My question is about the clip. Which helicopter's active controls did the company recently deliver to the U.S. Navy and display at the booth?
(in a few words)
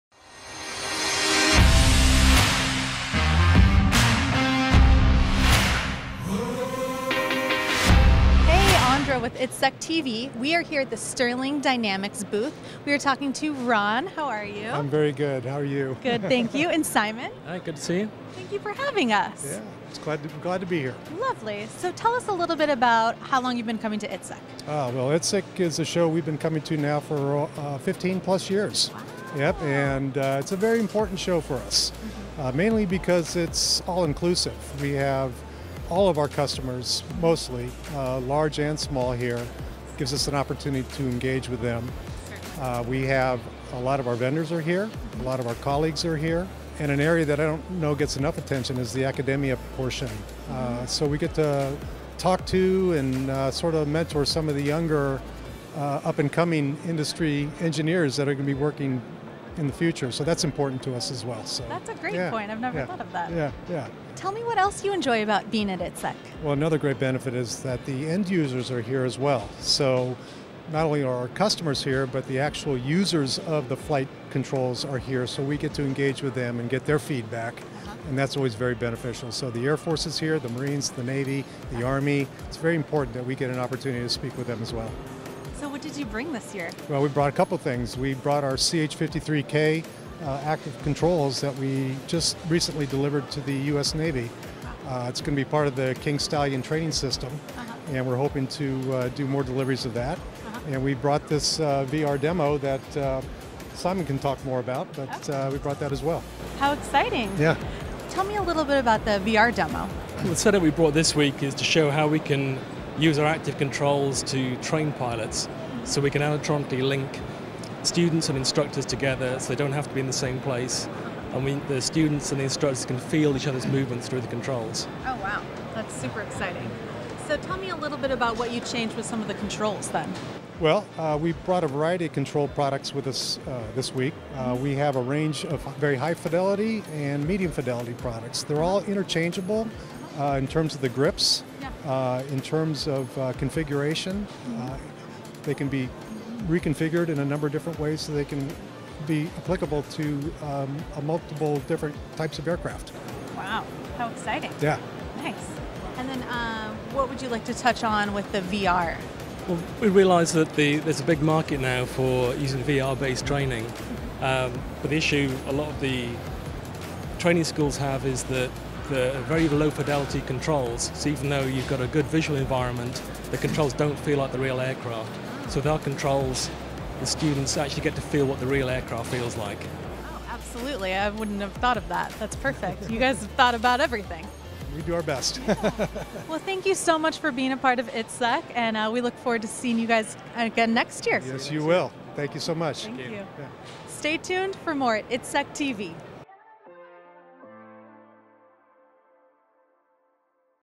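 CH-53K.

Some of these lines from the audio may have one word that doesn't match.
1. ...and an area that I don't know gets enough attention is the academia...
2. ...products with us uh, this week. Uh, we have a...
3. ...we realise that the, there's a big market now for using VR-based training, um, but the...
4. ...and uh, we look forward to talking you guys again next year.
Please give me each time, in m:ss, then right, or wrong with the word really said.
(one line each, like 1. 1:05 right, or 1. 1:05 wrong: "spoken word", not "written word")
1. 0:46 right
2. 2:12 right
3. 2:39 right
4. 3:08 wrong: "seeing", not "talking".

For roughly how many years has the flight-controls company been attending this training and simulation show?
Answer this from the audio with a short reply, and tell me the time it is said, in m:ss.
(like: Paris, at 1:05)
15 plus years, at 0:27.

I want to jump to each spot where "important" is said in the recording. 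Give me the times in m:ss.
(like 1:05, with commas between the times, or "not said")
0:30, 1:00, 1:22.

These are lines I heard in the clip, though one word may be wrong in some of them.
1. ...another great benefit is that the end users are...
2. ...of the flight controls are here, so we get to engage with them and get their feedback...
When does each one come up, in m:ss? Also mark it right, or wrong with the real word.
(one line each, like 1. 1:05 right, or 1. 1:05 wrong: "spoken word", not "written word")
1. 1:06 right
2. 1:13 right.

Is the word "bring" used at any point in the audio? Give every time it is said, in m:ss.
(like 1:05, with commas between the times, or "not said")
1:26.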